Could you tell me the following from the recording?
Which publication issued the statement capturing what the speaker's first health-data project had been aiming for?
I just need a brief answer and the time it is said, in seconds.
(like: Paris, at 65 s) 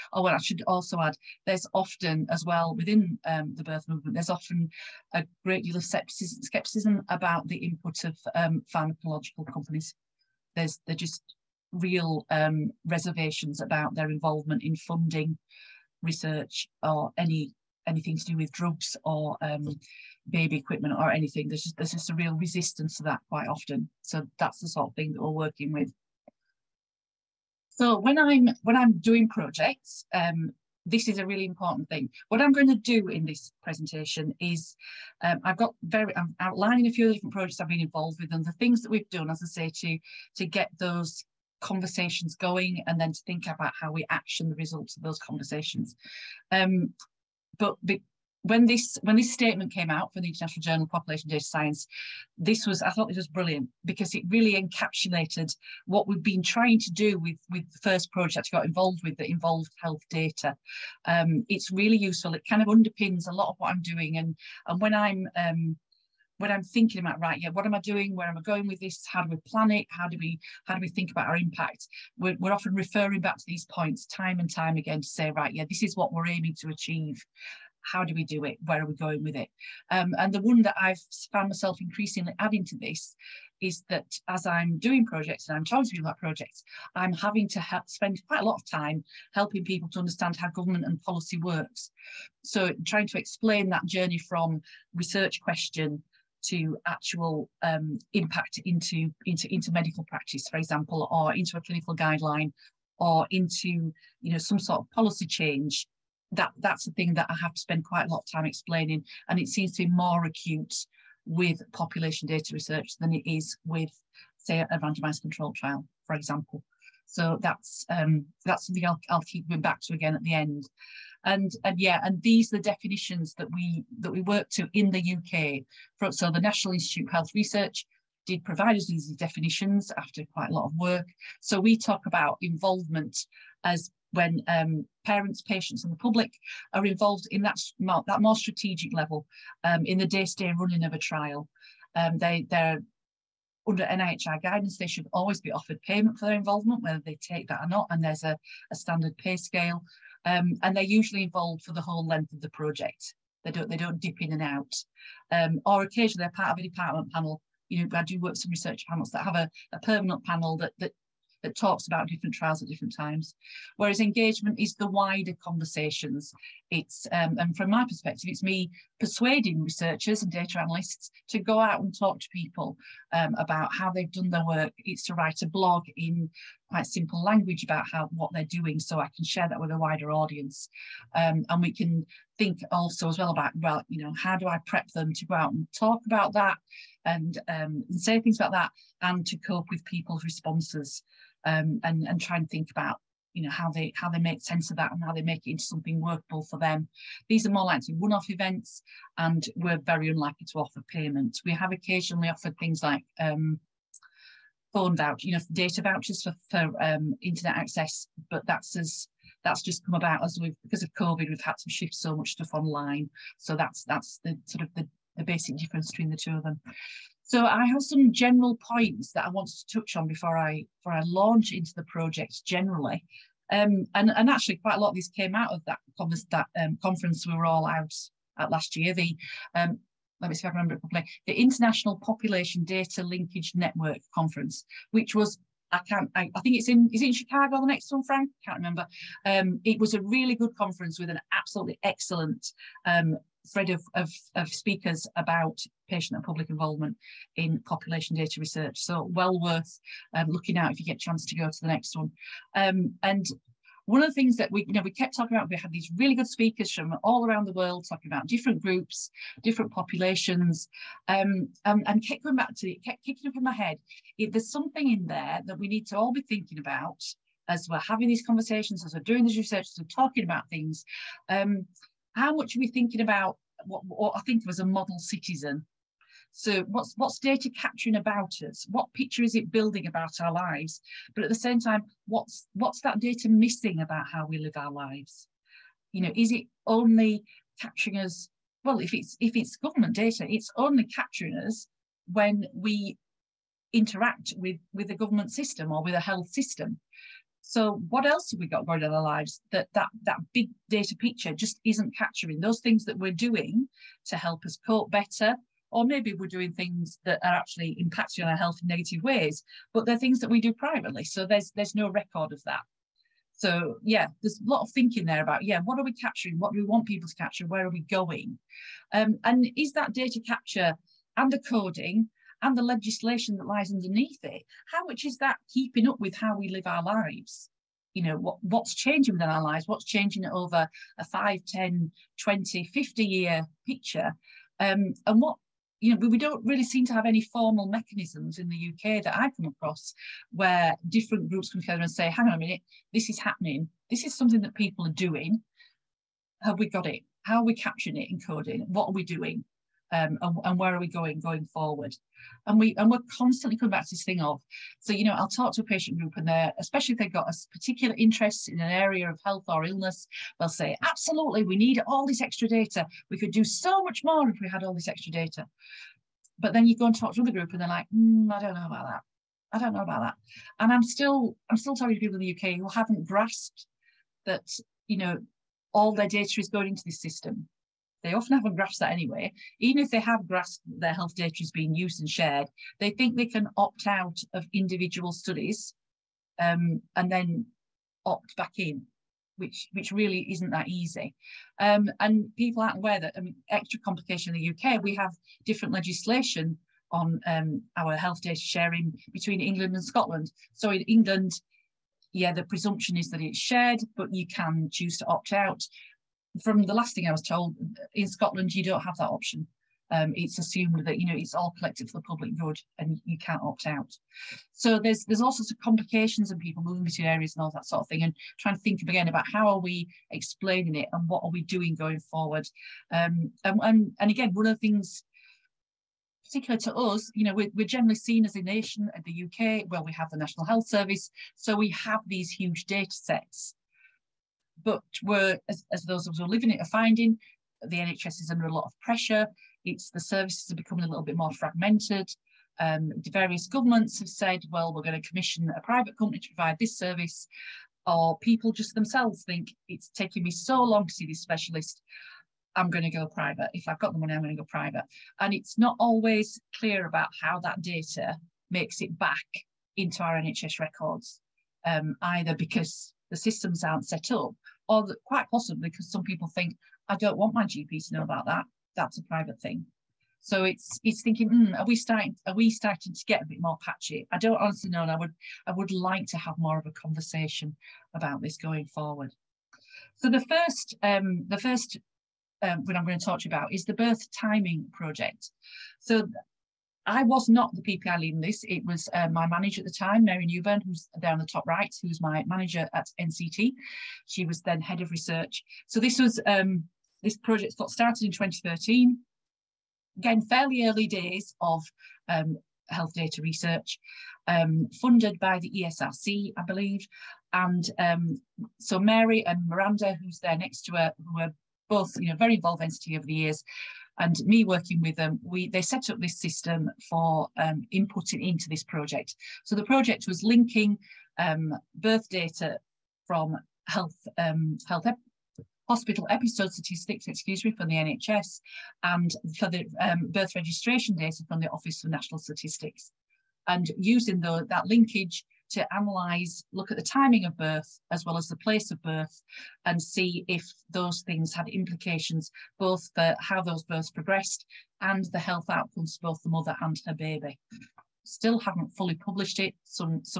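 International Journal of Population Data Science, at 50 s.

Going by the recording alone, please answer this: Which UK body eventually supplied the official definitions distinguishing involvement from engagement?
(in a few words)
National Institute of Health Research.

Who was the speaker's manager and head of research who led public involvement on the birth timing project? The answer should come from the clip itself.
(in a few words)
Mary Newburn.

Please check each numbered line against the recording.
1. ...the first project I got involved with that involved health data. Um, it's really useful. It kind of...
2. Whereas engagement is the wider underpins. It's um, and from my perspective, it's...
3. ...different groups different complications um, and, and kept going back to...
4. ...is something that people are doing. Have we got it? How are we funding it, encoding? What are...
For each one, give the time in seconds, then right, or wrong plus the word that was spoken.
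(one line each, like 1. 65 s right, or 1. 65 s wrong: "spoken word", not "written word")
1. 57 s right
2. 163 s wrong: "conversations", not "underpins"
3. 258 s wrong: "populations", not "complications"
4. 344 s wrong: "capturing", not "funding".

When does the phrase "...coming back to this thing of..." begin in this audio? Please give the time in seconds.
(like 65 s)
353 s.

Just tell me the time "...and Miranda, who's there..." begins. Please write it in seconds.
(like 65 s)
509 s.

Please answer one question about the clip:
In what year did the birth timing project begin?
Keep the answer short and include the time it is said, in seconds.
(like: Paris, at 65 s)
2013, at 498 s.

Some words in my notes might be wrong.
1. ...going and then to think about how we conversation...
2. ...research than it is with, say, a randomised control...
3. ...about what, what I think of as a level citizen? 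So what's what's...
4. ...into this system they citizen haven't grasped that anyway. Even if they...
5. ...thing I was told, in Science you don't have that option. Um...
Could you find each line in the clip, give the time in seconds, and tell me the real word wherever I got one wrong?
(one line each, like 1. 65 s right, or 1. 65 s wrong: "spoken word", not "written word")
1. 42 s wrong: "action", not "conversation"
2. 112 s right
3. 273 s wrong: "model", not "level"
4. 376 s wrong: "often", not "citizen"
5. 406 s wrong: "Scotland", not "Science".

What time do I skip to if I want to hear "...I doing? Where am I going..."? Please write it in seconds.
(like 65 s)
67 s.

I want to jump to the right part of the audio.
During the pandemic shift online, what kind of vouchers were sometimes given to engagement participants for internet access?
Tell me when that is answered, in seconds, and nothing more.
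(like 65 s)
205 s.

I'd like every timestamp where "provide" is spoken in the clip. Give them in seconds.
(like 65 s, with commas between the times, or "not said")
128 s, 446 s.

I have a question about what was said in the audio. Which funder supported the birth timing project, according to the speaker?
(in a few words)
ESRC.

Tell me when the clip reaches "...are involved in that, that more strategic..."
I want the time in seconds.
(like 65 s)
136 s.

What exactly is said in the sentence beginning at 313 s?
So yeah, there's a lot of thinking there about yeah, what are we capturing?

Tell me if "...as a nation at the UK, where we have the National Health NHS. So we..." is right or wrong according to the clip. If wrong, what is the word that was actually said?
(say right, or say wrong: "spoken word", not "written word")
wrong: "Service", not "NHS".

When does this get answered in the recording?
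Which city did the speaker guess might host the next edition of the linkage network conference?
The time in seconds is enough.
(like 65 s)
237 s.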